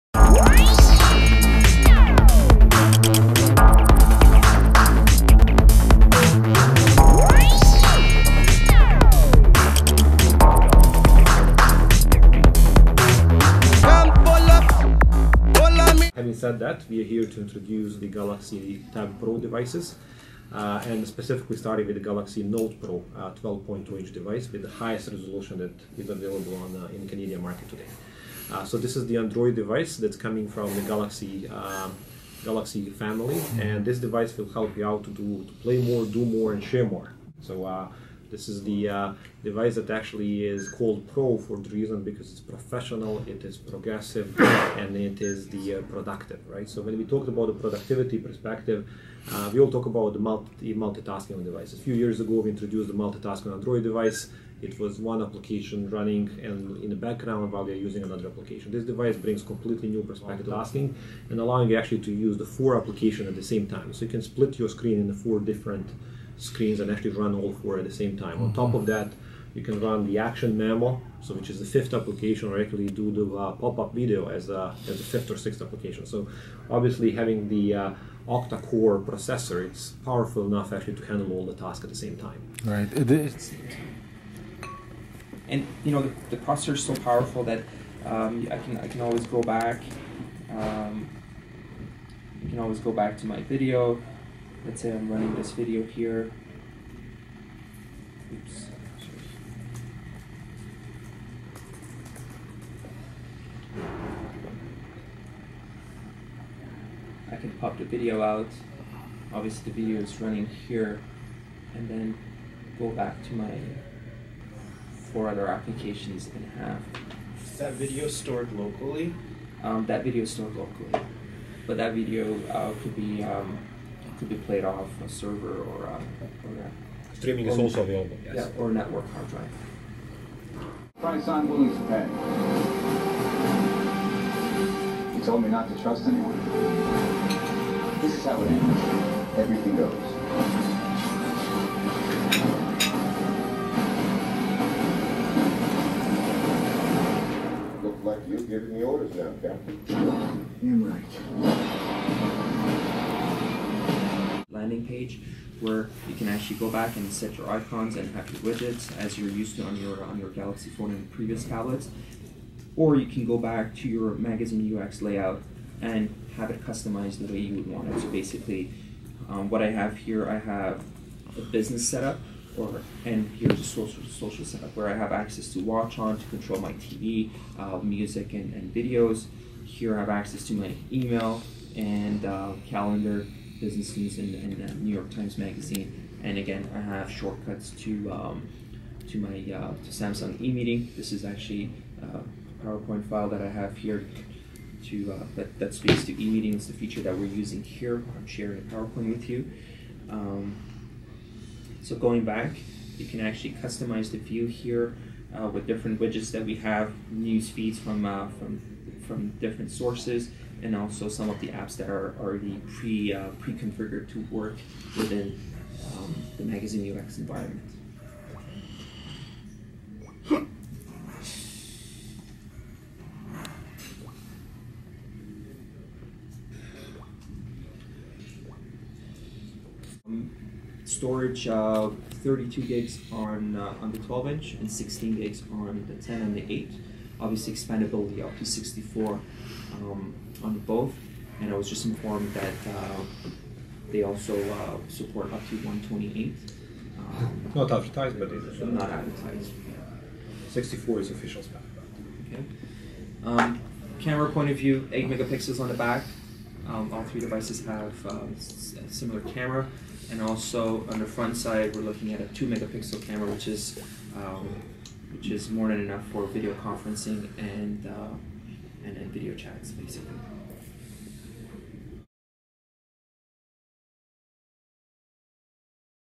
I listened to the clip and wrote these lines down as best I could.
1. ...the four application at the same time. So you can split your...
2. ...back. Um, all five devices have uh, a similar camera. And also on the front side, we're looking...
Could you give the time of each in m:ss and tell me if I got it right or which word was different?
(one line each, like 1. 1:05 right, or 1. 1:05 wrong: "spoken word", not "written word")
1. 1:02 right
2. 4:15 wrong: "three", not "five".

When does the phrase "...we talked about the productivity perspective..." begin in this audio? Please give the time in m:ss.
0:46.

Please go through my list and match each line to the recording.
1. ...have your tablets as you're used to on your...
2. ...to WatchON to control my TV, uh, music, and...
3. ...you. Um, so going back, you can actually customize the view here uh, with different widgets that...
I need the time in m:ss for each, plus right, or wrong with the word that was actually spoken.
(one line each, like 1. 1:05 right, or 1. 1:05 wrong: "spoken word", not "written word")
1. 2:38 wrong: "widgets", not "tablets"
2. 2:55 right
3. 3:19 right.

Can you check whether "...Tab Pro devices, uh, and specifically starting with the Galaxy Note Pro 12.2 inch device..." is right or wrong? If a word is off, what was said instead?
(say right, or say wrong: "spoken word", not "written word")
right.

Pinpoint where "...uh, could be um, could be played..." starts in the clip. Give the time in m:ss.
2:02.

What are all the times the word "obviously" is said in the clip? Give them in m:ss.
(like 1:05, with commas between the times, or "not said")
1:16, 1:49, 3:57.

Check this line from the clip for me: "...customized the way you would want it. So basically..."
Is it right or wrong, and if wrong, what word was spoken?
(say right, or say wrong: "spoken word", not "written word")
right.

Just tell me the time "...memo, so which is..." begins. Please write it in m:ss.
1:10.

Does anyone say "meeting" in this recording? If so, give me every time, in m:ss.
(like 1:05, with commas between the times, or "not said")
3:10, 3:16.